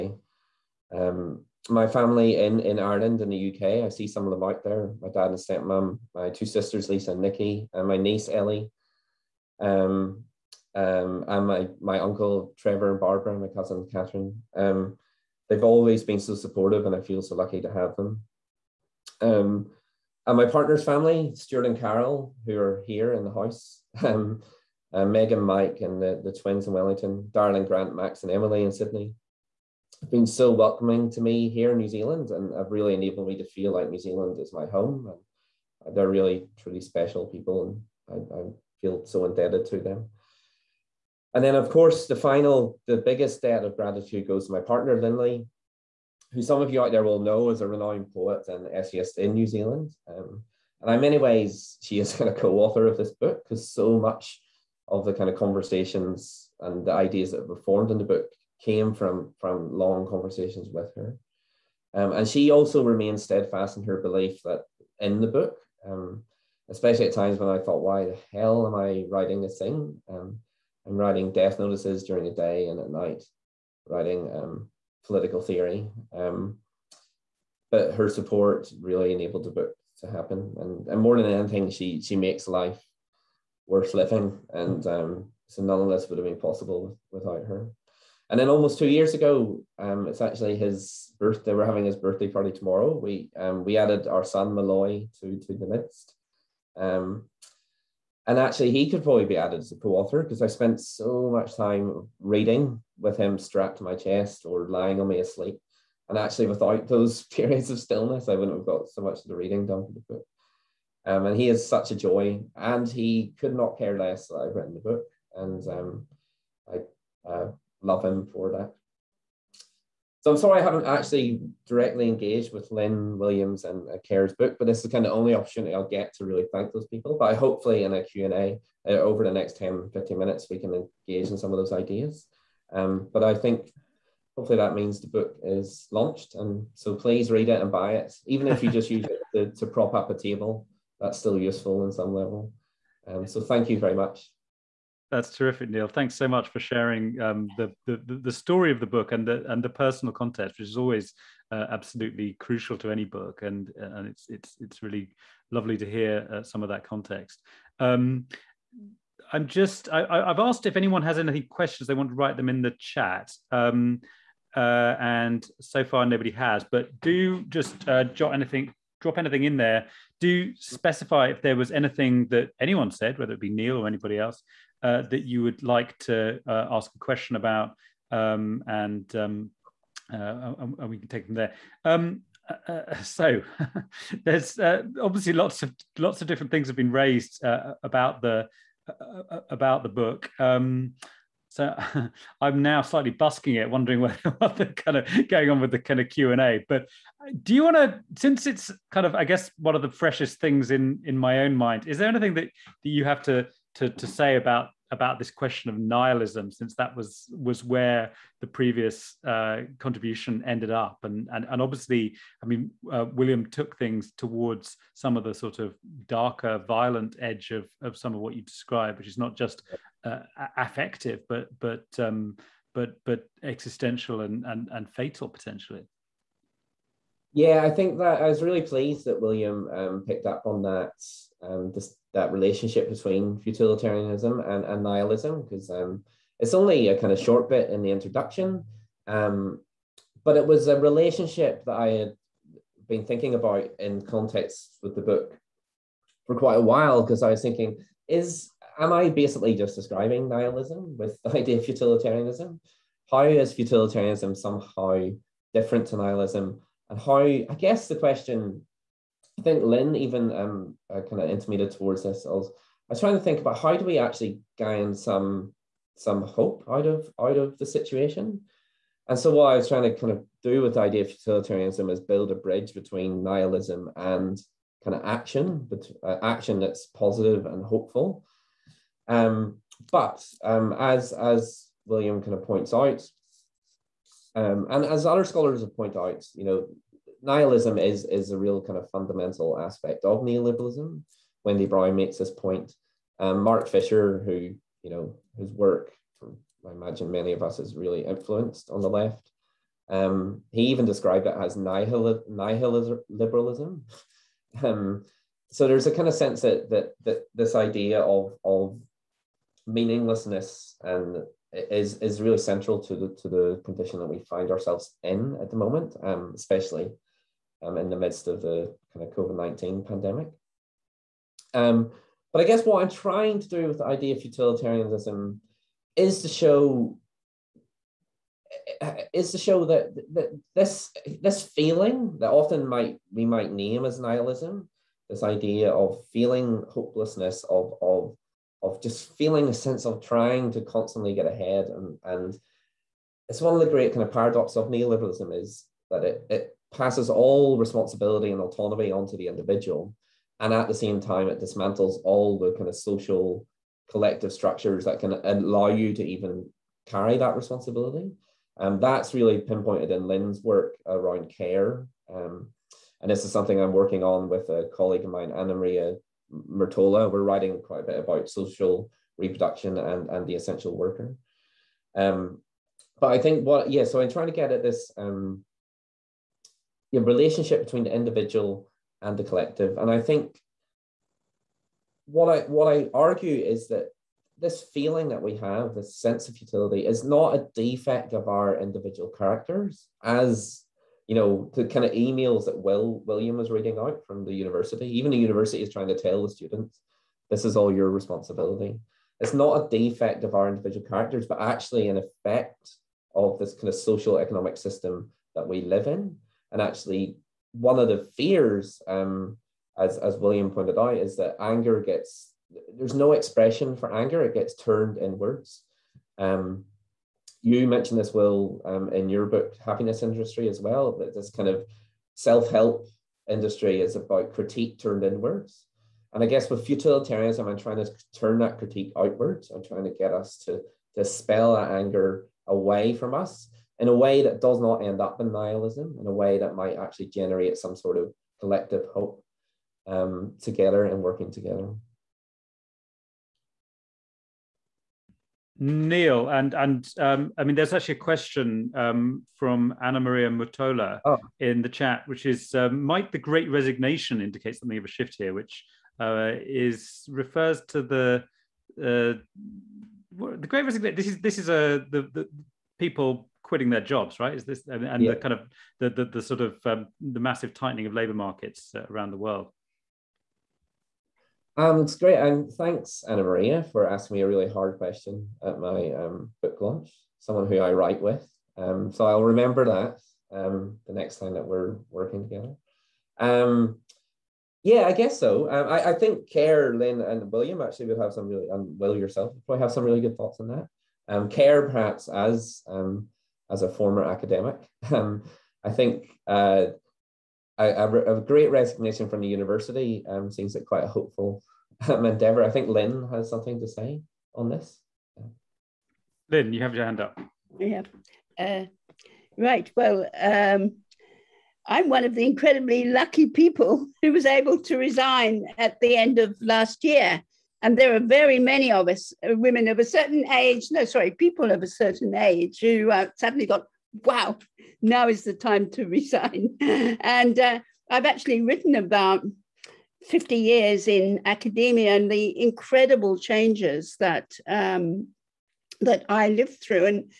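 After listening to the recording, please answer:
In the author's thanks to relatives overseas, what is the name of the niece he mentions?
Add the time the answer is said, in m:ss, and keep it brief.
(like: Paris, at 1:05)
Ellie, at 0:08.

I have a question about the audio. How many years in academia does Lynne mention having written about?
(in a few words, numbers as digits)
50.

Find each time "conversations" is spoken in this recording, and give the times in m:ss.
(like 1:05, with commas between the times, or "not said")
0:55, 1:00.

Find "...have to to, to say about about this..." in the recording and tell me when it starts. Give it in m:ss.
3:23.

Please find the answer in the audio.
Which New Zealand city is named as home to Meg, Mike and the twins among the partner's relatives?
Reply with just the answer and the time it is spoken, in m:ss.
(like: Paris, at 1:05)
Wellington, at 0:26.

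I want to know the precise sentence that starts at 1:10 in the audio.
Um, I'm writing death notices during the day and at night, writing um, political theory.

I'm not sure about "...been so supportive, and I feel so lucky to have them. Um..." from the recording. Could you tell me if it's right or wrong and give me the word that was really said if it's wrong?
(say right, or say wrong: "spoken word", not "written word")
right.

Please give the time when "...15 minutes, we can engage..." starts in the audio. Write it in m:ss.
2:09.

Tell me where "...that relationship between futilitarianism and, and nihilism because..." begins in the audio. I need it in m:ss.
3:52.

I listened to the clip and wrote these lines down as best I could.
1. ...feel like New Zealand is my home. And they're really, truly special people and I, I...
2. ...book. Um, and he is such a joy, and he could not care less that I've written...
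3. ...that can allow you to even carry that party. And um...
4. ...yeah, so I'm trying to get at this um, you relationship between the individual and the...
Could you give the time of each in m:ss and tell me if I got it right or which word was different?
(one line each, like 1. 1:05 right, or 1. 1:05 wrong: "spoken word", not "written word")
1. 0:33 right
2. 1:50 right
3. 5:54 wrong: "responsibility", not "party"
4. 6:13 right.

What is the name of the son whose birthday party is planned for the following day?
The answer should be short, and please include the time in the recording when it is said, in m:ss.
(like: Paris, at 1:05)
Malloy, at 1:34.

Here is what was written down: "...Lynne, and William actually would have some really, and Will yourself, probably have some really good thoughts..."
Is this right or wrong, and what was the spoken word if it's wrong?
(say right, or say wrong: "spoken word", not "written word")
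right.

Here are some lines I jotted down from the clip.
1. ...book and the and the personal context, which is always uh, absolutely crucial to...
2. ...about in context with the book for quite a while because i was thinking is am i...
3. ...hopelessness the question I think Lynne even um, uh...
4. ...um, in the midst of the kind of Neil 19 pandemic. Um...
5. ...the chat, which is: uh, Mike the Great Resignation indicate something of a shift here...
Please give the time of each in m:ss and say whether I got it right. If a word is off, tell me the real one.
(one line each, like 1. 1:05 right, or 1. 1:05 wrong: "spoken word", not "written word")
1. 2:28 right
2. 4:03 right
3. 4:17 wrong: "guess", not "hopelessness"
4. 5:17 wrong: "COVID", not "Neil"
5. 7:31 wrong: "Might", not "Mike".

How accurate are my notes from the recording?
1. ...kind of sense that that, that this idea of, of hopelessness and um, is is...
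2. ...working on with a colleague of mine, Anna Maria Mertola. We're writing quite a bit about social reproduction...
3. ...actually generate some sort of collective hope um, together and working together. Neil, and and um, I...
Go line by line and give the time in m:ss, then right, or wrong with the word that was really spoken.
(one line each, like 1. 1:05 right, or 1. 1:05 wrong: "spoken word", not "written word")
1. 5:05 wrong: "meaninglessness", not "hopelessness"
2. 6:03 right
3. 7:16 right.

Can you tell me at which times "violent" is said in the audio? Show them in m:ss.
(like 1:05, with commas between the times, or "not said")
3:36.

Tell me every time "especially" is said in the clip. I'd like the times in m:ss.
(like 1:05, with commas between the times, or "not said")
1:06, 5:16.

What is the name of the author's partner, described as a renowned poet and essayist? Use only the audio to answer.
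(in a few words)
Linley.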